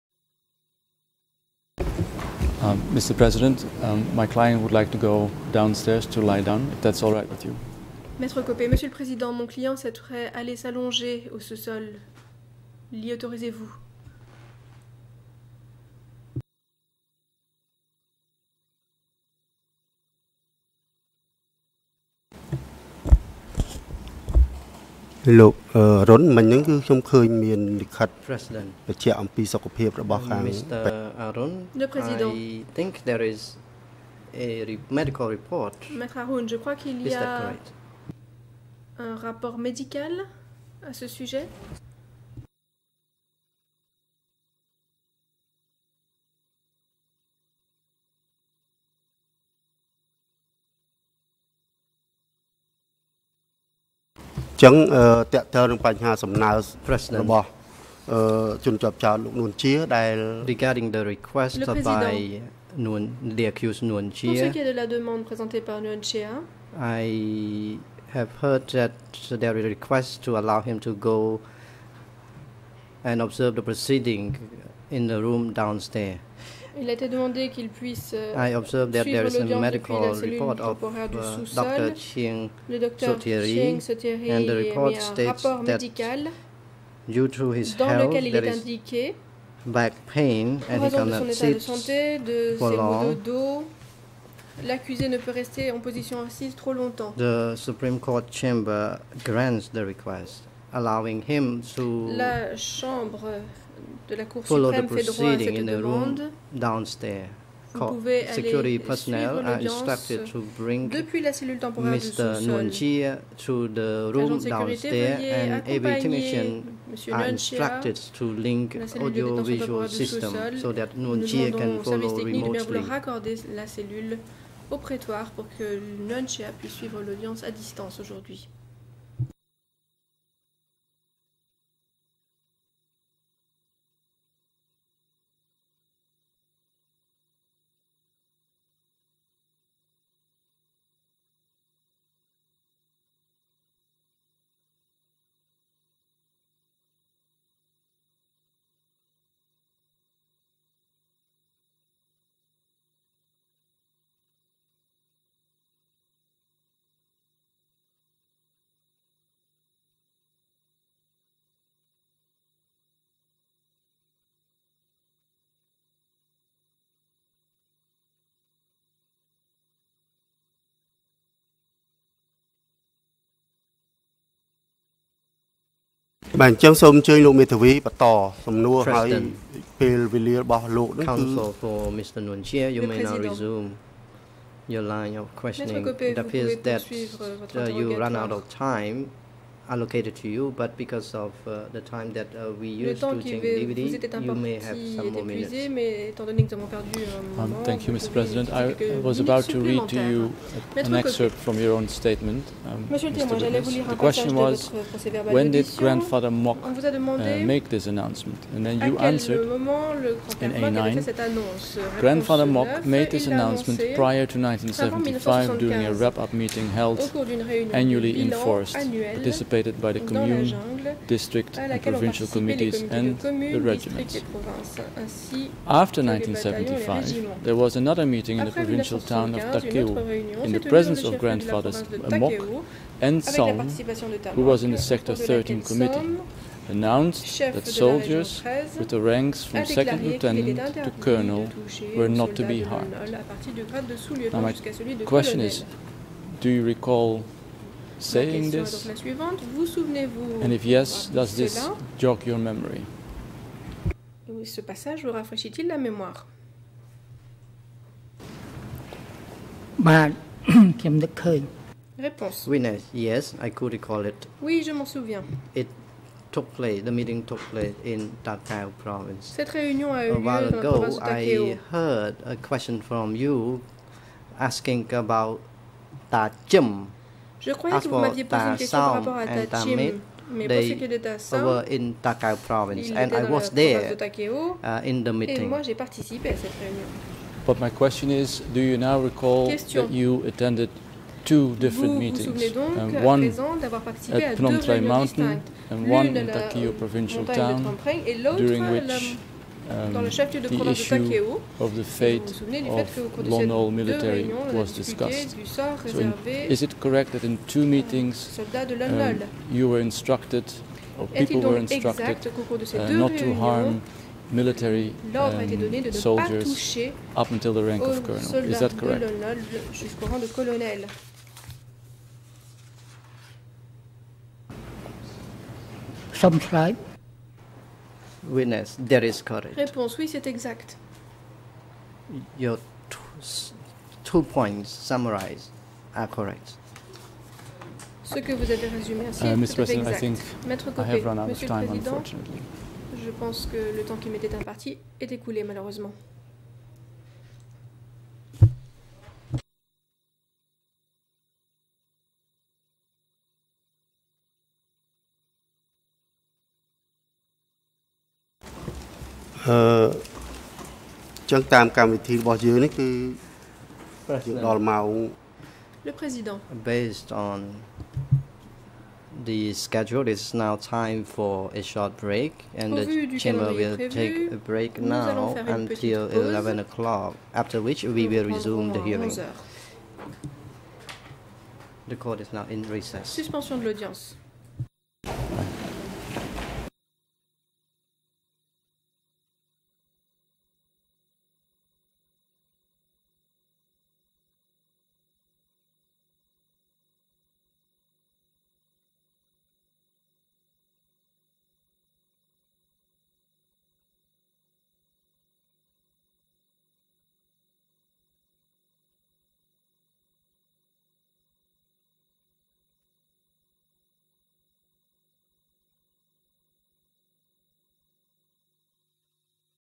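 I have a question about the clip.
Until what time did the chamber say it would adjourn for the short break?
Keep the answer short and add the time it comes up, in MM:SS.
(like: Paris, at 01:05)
11 o'clock, at 06:16.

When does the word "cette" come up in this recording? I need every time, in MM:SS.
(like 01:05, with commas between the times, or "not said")
01:45, 04:29, 04:46.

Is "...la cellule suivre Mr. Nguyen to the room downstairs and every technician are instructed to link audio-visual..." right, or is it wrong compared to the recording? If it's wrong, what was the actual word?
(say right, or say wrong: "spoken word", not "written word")
wrong: "temporaire", not "suivre".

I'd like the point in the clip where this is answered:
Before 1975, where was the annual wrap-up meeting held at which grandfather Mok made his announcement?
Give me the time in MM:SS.
03:38.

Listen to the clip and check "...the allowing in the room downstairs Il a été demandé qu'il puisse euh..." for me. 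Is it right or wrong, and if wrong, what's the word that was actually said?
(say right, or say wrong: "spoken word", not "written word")
wrong: "proceeding", not "allowing".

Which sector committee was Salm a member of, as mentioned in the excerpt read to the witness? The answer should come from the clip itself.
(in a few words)
Sector 13.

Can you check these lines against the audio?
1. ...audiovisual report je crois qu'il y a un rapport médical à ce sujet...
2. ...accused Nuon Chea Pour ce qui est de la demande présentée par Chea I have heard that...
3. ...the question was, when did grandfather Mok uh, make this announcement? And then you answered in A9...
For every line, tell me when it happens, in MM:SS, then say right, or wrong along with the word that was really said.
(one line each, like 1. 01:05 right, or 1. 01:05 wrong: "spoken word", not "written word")
1. 00:34 wrong: "medical", not "audiovisual"
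2. 01:03 right
3. 03:22 right.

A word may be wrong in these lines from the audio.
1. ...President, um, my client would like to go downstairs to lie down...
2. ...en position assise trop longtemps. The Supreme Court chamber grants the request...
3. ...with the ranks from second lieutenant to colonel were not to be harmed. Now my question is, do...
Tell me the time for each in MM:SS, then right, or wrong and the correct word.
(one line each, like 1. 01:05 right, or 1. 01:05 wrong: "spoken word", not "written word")
1. 00:03 right
2. 01:35 right
3. 03:58 right.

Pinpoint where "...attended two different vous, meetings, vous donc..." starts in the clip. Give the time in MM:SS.
04:50.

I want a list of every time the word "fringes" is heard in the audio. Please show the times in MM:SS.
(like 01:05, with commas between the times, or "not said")
not said.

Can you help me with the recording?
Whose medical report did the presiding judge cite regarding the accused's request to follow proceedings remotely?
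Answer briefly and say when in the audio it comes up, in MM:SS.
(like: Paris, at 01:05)
Dr. Ching Sotiri, at 01:21.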